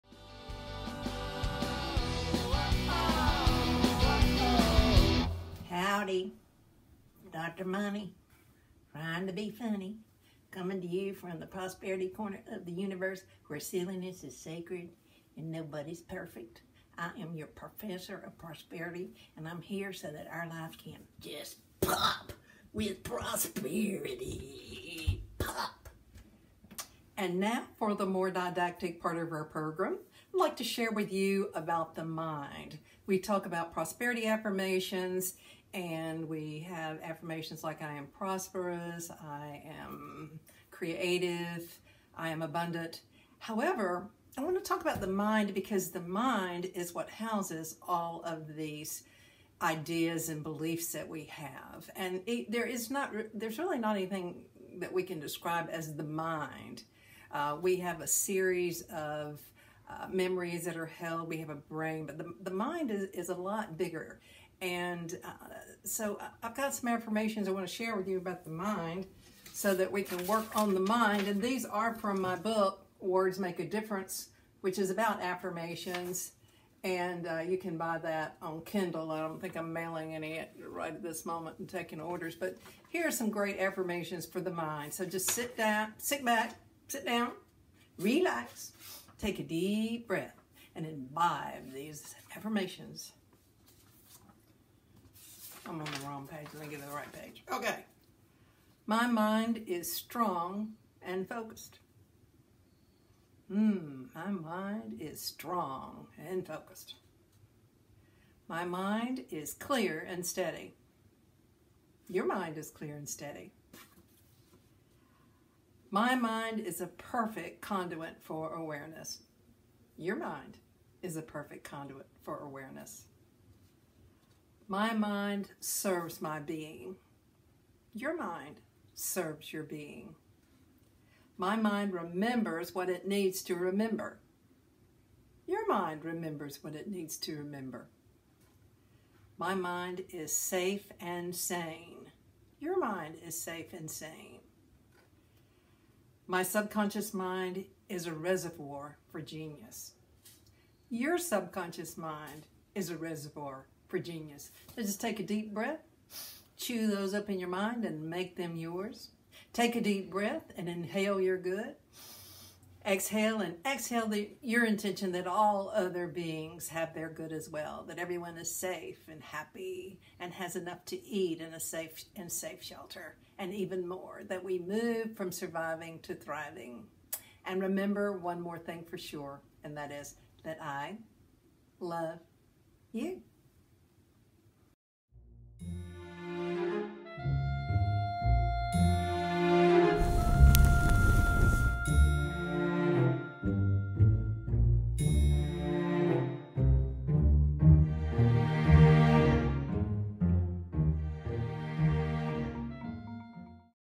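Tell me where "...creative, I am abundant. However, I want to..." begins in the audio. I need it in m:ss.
0:40.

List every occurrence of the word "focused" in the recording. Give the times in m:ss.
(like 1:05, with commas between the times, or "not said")
1:41, 1:46.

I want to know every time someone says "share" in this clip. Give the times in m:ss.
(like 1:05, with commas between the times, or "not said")
0:30, 1:07.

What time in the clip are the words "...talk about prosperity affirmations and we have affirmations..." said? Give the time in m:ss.
0:33.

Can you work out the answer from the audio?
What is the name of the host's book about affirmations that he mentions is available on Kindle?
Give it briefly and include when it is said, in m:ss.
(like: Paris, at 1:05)
Words Make a Difference, at 1:13.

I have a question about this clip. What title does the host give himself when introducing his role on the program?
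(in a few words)
professor of prosperity.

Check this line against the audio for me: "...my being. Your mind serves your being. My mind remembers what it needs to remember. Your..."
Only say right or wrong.
right.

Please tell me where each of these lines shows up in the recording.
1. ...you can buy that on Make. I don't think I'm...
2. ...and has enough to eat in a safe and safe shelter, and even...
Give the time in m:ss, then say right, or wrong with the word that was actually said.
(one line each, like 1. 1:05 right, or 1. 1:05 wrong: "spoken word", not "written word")
1. 1:17 wrong: "Kindle", not "Make"
2. 2:50 right.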